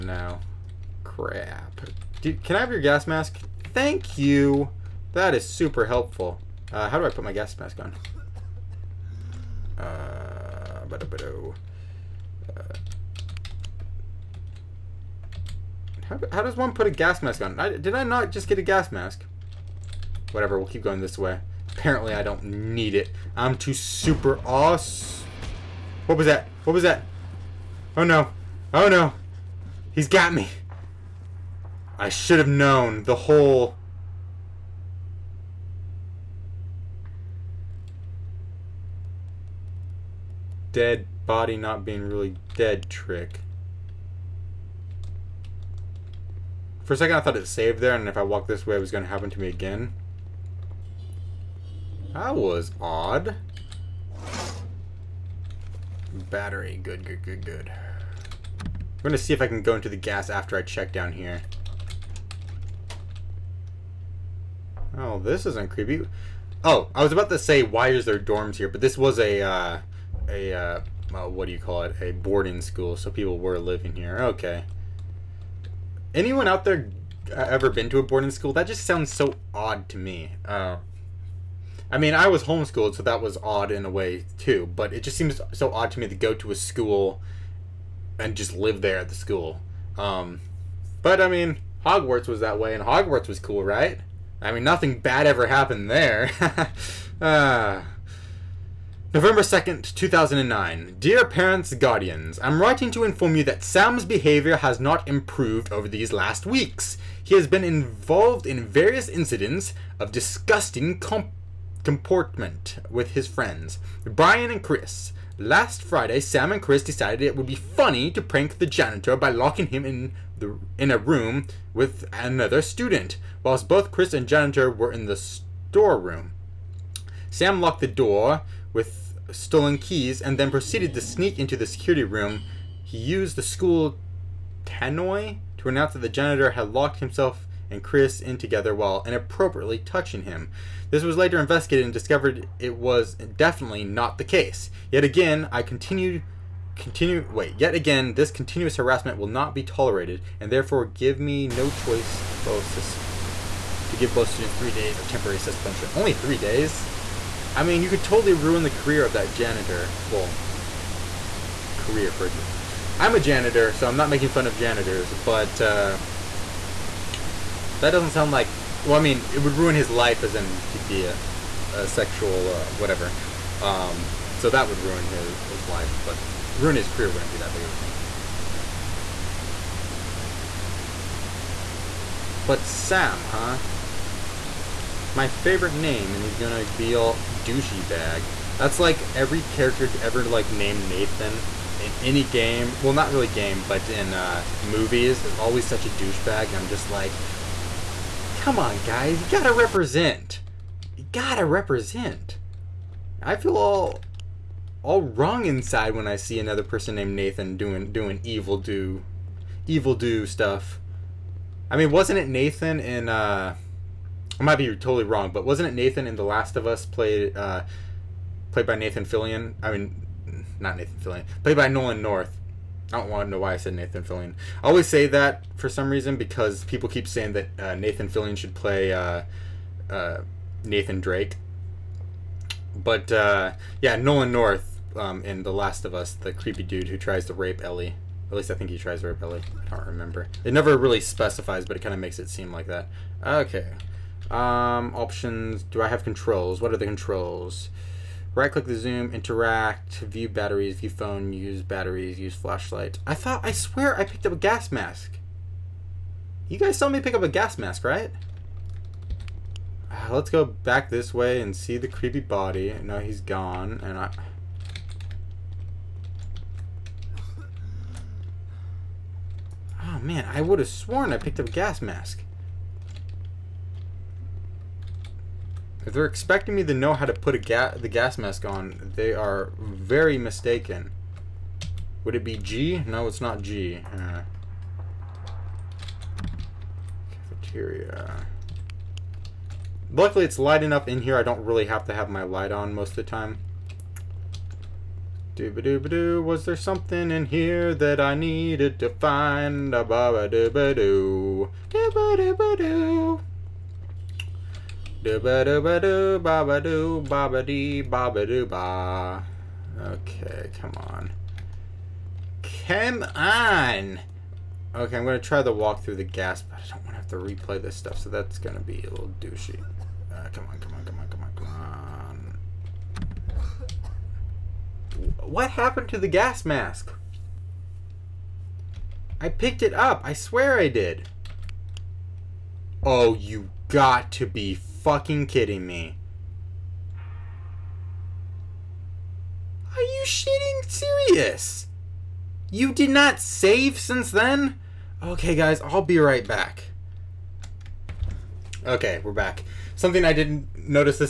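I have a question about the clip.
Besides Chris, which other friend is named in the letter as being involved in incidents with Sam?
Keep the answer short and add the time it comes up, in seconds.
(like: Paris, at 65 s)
Brian, at 114 s.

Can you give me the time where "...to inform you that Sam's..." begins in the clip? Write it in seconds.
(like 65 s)
102 s.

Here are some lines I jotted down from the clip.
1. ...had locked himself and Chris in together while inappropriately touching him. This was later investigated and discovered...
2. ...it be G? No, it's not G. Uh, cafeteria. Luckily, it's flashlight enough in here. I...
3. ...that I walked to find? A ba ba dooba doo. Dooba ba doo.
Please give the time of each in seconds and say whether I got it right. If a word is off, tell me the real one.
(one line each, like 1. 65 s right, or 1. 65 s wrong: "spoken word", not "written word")
1. 136 s right
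2. 282 s wrong: "light", not "flashlight"
3. 297 s wrong: "needed", not "walked".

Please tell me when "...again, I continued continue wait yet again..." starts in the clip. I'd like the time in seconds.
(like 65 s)
145 s.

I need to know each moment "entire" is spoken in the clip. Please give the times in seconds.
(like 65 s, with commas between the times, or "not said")
not said.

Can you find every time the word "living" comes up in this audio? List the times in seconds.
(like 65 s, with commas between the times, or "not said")
73 s.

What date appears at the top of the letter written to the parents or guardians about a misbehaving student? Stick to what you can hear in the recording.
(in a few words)
November 2nd, 2009.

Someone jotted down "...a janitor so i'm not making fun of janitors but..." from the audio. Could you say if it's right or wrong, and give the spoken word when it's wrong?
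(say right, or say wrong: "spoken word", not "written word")
right.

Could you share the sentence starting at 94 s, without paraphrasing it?
I mean, nothing bad ever happened there.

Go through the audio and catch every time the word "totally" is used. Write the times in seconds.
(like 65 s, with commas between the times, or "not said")
158 s, 214 s.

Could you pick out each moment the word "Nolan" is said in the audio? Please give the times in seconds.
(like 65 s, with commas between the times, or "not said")
221 s, 233 s.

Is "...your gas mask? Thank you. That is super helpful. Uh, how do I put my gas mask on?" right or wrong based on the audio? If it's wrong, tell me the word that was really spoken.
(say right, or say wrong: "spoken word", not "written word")
right.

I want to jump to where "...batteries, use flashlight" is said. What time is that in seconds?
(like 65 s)
251 s.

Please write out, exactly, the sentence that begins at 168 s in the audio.
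Well, I mean, it would ruin his life, as in he'd be a, a sexual uh, whatever.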